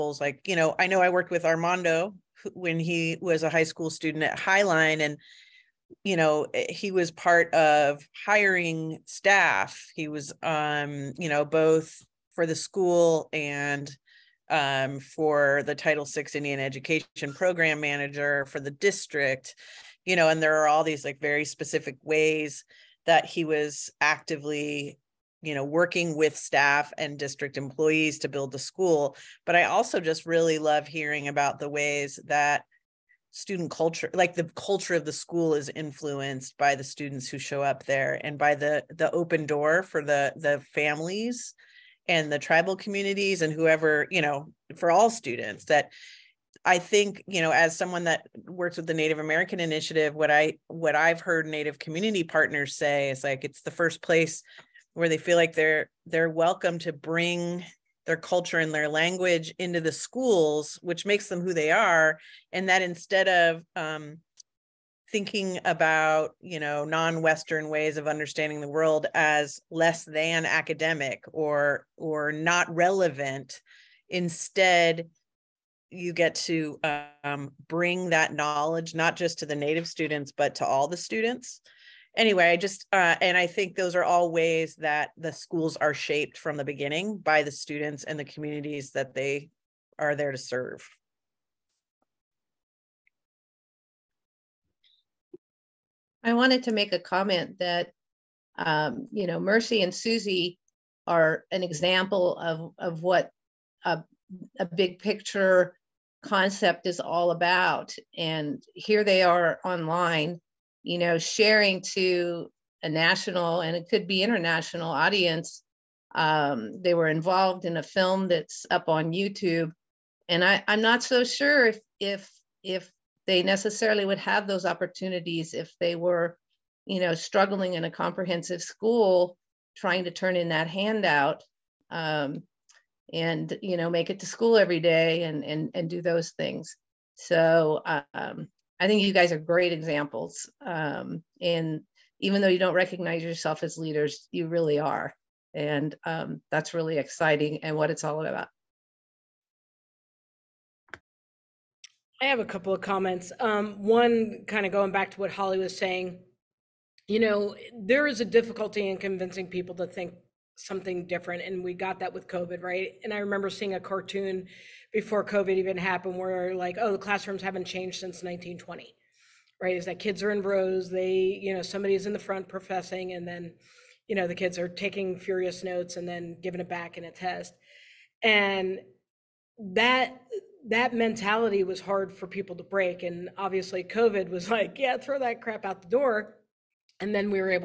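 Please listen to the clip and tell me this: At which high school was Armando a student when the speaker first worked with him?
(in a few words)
Highline.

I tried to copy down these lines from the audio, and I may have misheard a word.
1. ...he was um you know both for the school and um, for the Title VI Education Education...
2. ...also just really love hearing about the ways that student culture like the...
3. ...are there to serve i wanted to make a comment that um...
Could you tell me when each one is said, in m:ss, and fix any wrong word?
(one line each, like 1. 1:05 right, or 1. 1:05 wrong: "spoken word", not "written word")
1. 0:09 wrong: "Indian", not "Education"
2. 0:29 right
3. 1:29 right.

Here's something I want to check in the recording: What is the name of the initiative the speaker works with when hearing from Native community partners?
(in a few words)
Native American Initiative.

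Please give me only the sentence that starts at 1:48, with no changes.
And here they are online, you know, sharing to a national and it could be international audience.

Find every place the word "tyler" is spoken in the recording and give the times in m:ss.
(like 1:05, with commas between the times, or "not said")
not said.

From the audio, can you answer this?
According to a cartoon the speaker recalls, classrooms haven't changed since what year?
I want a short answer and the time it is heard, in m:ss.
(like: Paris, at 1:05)
1920, at 2:48.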